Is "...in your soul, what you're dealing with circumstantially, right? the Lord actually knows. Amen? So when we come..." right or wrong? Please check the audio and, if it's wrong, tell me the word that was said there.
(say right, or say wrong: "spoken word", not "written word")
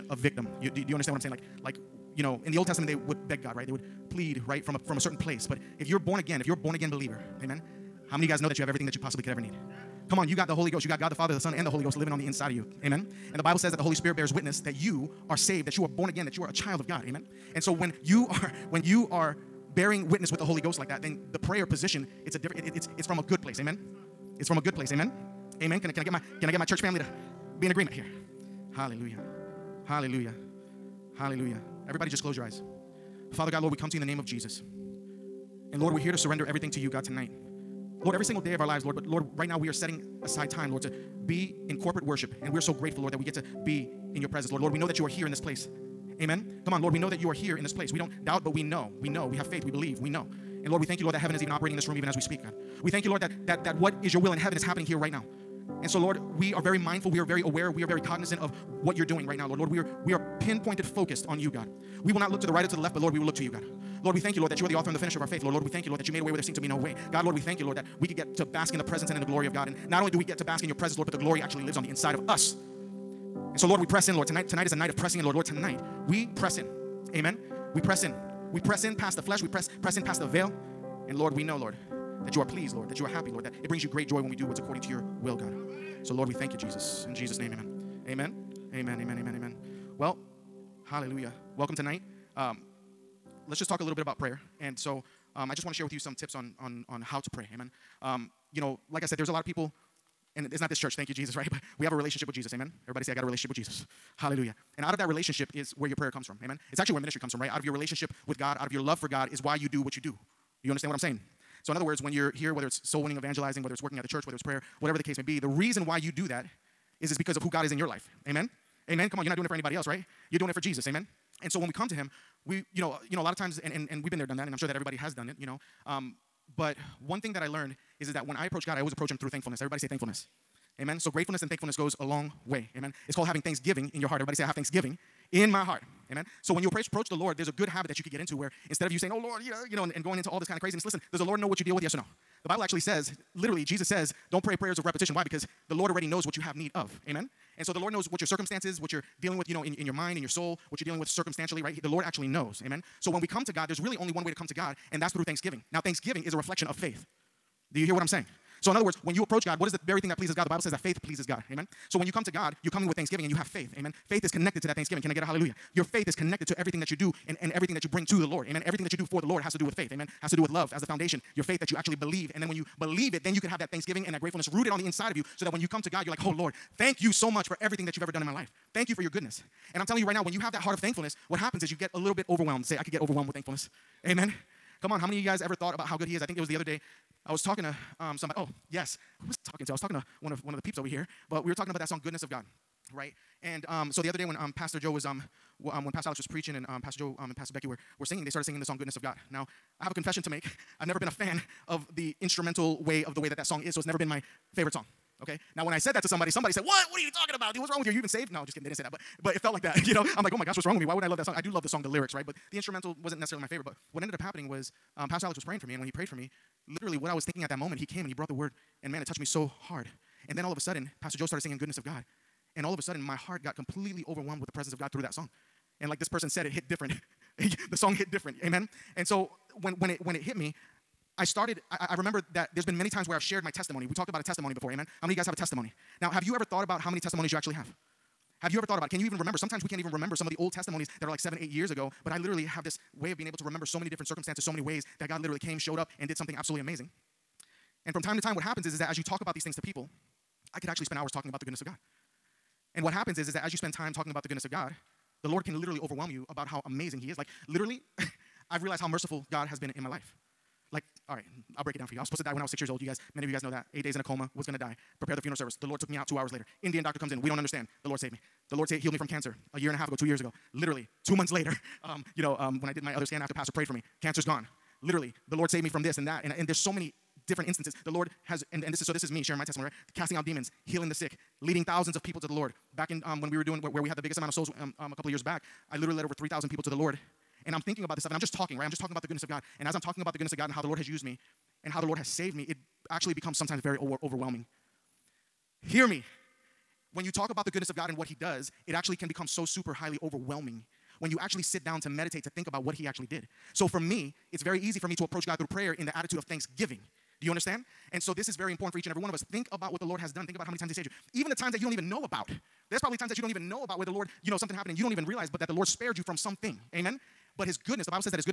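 right.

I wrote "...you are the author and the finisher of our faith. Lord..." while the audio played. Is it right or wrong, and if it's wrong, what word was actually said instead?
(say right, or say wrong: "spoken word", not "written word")
right.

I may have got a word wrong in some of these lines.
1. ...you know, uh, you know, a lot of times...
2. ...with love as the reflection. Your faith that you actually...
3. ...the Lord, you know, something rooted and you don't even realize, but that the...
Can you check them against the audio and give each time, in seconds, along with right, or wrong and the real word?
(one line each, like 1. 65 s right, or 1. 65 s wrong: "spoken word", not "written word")
1. 122 s right
2. 170 s wrong: "foundation", not "reflection"
3. 313 s wrong: "happened", not "rooted".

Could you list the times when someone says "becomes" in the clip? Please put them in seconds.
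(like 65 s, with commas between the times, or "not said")
293 s, 299 s.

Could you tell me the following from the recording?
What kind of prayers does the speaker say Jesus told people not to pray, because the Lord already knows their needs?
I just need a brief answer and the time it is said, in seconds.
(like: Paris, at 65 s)
prayers of repetition, at 144 s.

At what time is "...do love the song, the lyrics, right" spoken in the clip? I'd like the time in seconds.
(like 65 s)
211 s.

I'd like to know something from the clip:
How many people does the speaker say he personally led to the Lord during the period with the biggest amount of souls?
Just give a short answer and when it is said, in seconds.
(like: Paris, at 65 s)
over 3,000, at 286 s.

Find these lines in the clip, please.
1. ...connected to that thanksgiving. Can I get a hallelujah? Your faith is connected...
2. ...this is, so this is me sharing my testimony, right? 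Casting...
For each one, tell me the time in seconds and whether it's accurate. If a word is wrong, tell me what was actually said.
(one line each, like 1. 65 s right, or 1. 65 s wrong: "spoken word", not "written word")
1. 164 s right
2. 278 s right.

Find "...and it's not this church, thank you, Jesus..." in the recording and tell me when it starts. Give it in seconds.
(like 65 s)
100 s.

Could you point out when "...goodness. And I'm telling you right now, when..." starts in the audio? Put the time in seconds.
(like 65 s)
179 s.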